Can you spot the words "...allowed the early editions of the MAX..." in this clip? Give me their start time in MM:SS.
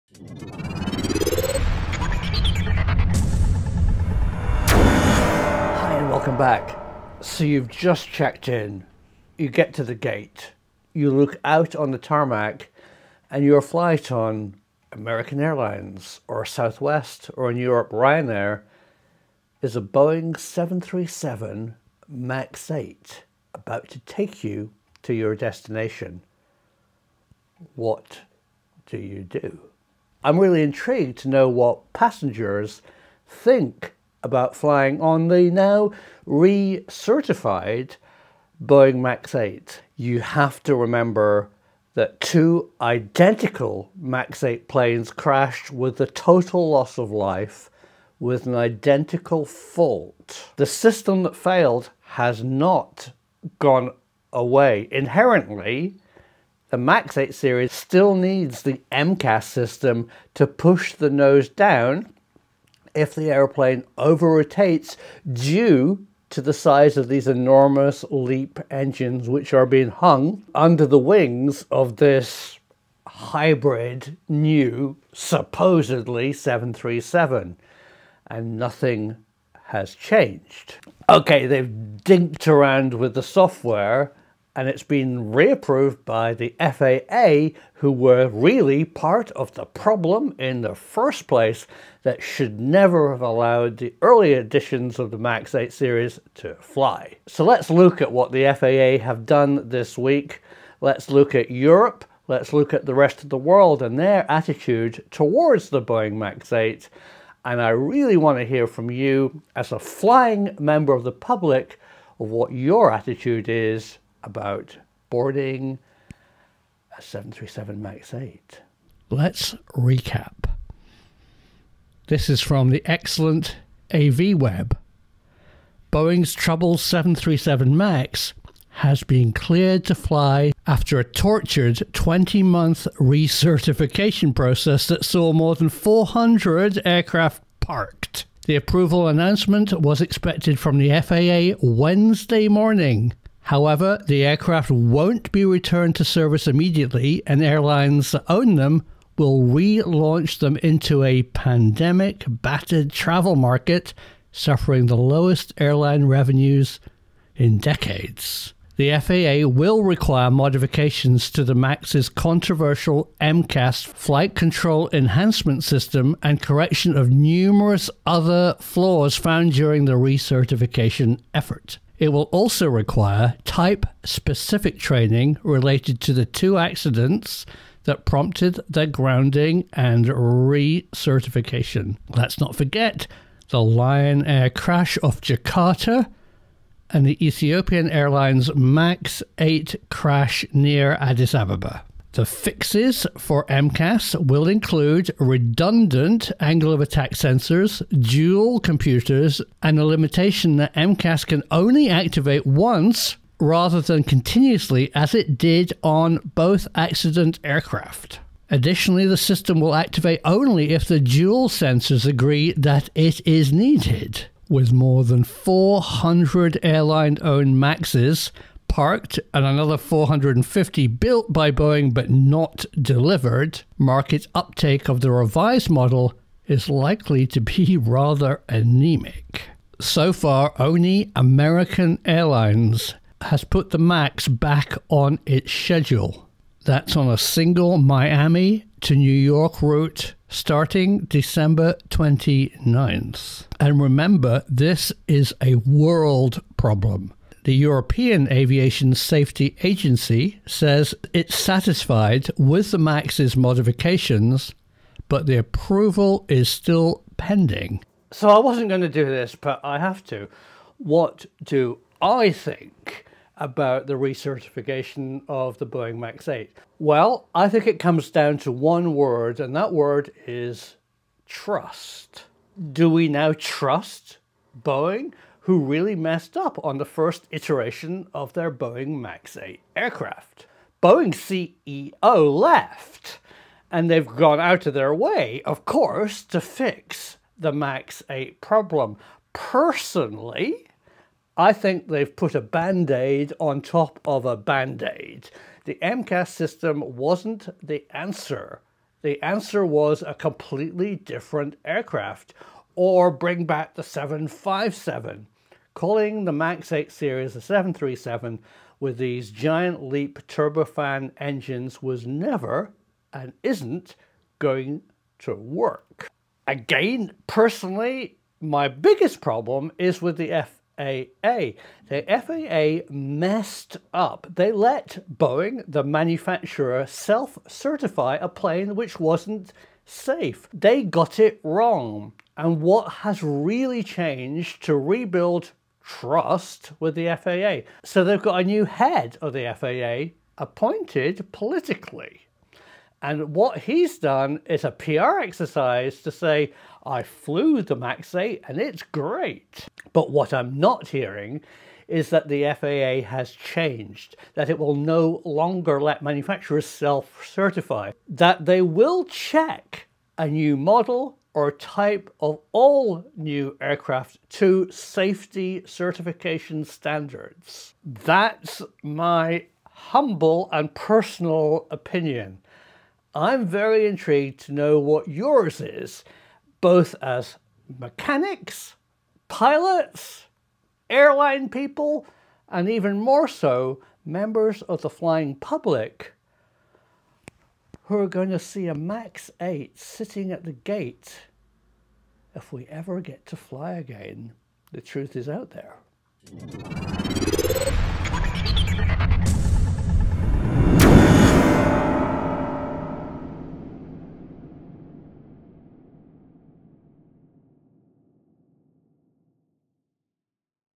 01:33.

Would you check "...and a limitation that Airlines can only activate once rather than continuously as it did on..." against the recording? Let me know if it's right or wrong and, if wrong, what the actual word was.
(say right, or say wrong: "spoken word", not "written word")
wrong: "MCAS", not "Airlines".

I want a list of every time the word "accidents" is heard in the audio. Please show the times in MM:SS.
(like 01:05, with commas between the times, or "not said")
02:56, 03:26.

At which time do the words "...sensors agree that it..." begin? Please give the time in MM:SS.
03:31.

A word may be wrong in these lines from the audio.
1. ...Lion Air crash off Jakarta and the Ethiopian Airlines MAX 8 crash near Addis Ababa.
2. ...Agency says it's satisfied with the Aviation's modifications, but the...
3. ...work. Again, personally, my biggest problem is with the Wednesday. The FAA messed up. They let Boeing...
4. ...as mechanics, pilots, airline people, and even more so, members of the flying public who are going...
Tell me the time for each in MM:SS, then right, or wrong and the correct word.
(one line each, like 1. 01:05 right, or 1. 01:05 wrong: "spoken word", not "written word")
1. 03:03 right
2. 04:09 wrong: "MAX", not "Aviation"
3. 05:15 wrong: "FAA", not "Wednesday"
4. 06:17 right.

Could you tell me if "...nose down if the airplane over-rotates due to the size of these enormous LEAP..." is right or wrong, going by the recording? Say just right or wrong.
right.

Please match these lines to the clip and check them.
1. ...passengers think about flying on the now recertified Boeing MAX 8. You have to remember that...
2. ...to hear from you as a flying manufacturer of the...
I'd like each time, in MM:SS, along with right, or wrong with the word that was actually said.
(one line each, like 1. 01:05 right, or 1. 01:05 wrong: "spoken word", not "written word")
1. 00:31 right
2. 01:48 wrong: "member", not "manufacturer".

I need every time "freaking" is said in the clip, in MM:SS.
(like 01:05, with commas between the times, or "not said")
not said.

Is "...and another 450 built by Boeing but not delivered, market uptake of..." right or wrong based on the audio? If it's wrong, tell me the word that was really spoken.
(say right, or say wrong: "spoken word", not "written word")
right.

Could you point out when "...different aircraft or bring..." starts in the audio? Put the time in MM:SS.
05:00.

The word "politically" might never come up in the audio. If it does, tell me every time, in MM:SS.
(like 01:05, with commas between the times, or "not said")
05:41.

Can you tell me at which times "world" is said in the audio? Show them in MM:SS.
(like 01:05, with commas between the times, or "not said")
01:43, 04:05.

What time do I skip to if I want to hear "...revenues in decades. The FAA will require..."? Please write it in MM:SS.
02:36.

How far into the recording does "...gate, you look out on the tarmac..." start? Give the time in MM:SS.
00:09.